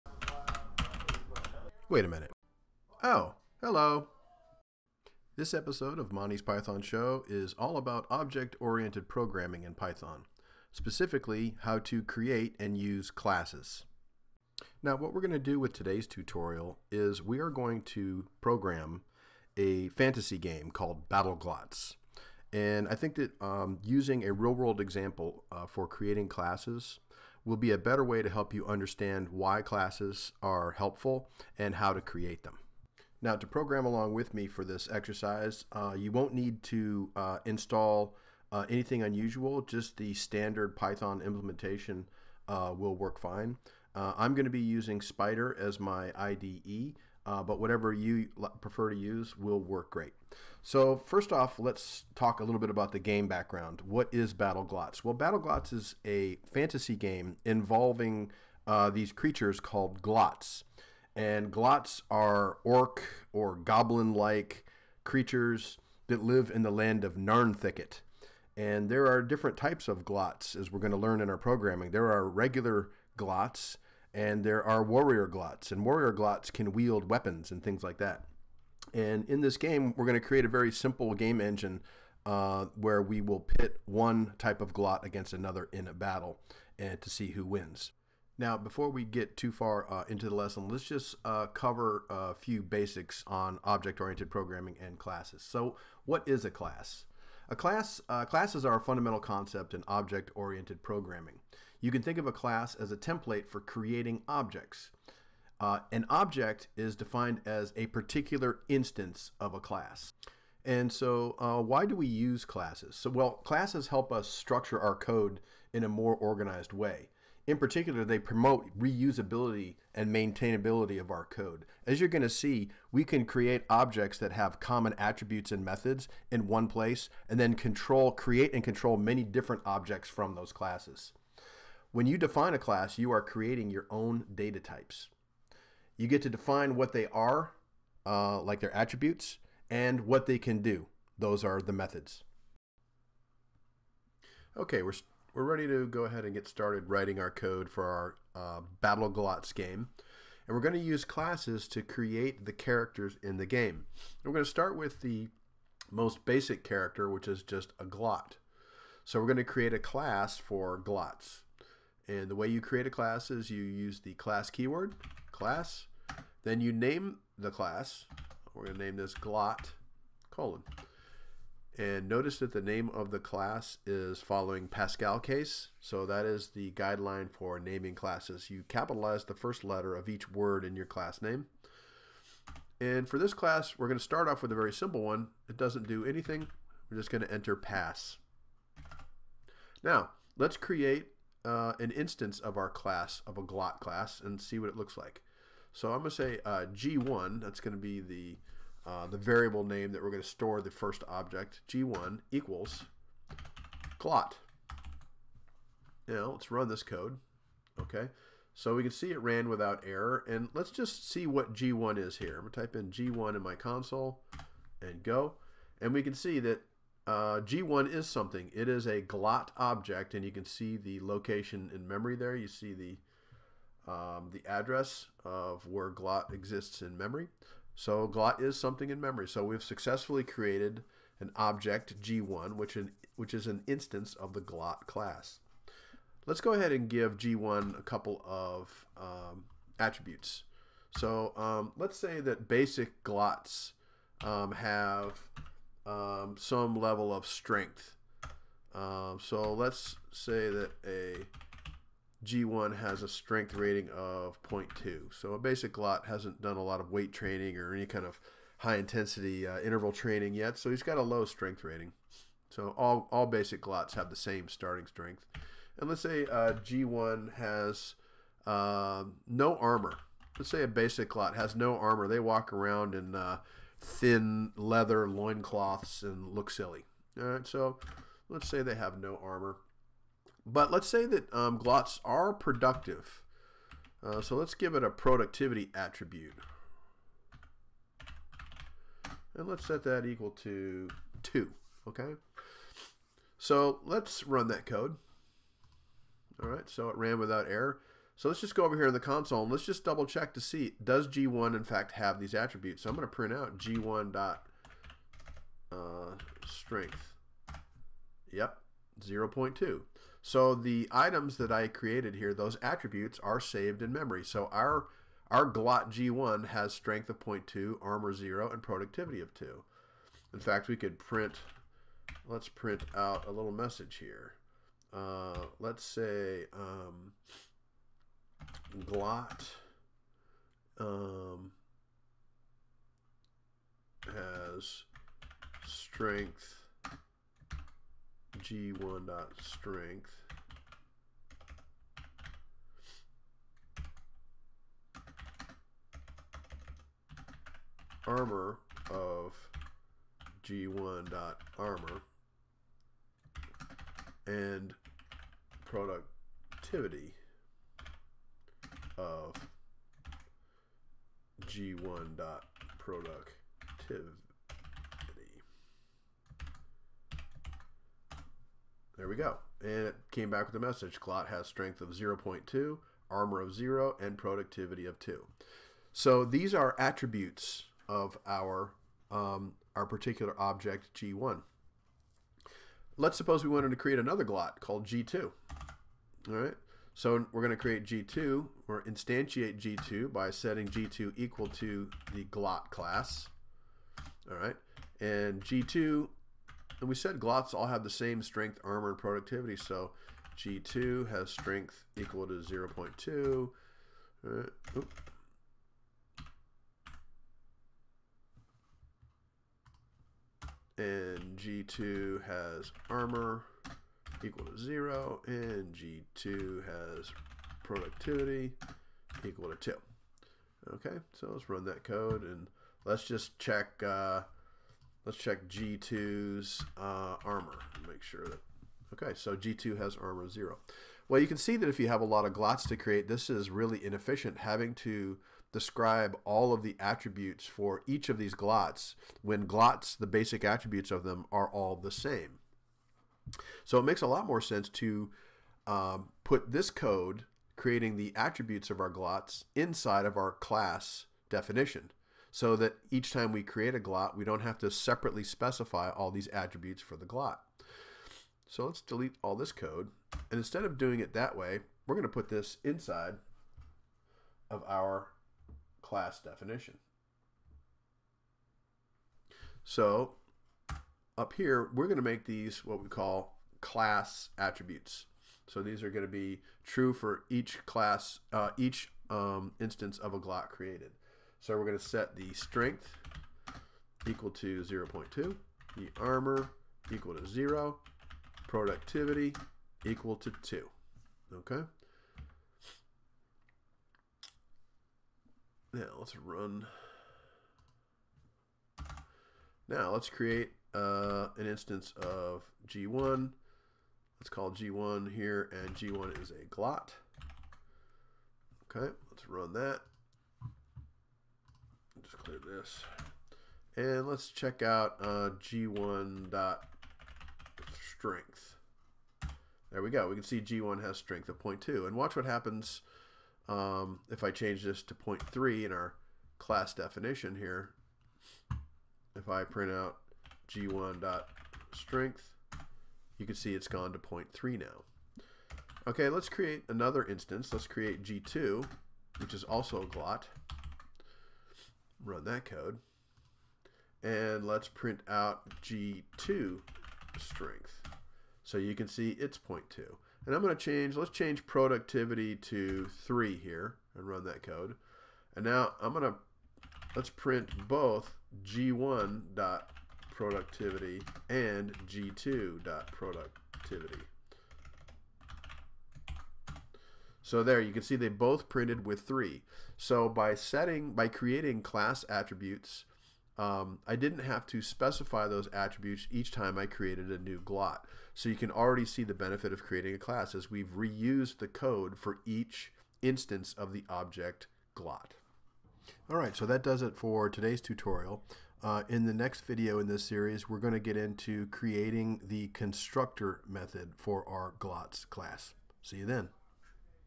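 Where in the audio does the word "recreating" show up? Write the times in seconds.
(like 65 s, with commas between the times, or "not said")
not said.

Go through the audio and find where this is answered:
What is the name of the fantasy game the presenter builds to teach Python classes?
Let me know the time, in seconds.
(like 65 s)
21 s.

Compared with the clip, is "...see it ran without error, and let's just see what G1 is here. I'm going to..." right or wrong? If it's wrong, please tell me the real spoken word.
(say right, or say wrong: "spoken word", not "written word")
right.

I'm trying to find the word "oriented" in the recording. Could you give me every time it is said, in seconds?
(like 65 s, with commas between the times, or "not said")
8 s, 93 s, 99 s.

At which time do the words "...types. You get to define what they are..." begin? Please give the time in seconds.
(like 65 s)
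134 s.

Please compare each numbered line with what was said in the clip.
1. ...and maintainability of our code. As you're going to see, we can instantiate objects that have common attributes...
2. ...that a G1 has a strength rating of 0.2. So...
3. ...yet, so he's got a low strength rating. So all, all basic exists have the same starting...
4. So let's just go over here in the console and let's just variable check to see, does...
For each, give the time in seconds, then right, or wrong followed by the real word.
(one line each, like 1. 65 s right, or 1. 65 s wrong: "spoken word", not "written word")
1. 119 s wrong: "create", not "instantiate"
2. 250 s right
3. 260 s wrong: "glots", not "exists"
4. 298 s wrong: "double", not "variable".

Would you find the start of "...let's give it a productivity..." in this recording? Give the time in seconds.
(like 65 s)
284 s.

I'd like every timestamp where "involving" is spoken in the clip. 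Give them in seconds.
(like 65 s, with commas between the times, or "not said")
57 s.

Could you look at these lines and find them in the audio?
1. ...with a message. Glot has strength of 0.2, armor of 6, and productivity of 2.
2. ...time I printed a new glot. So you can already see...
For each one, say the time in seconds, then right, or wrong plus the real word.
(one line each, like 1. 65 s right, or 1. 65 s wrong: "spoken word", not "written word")
1. 370 s wrong: "0", not "6"
2. 576 s wrong: "created", not "printed".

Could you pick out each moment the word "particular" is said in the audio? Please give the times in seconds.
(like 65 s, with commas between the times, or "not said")
107 s, 117 s, 379 s.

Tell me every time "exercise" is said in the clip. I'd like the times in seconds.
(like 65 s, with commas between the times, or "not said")
34 s.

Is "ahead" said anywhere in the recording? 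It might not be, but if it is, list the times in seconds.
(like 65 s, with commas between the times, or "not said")
146 s, 236 s.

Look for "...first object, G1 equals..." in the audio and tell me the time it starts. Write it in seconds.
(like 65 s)
200 s.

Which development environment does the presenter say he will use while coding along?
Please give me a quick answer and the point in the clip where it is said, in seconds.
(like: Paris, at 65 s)
Spyder, at 44 s.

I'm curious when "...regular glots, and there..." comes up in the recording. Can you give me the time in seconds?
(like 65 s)
72 s.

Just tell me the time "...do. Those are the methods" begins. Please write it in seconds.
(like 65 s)
140 s.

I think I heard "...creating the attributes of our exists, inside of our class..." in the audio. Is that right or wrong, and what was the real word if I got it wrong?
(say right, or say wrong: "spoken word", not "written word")
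wrong: "glots", not "exists".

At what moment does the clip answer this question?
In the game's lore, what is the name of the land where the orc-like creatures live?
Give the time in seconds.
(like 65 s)
67 s.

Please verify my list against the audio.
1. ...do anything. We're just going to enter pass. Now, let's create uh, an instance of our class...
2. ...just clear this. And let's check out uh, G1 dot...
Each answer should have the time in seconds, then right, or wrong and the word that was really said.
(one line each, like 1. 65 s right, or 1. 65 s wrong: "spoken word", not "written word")
1. 185 s right
2. 512 s right.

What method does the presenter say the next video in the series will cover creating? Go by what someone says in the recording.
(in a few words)
constructor method.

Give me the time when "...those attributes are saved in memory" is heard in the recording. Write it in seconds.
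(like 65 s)
312 s.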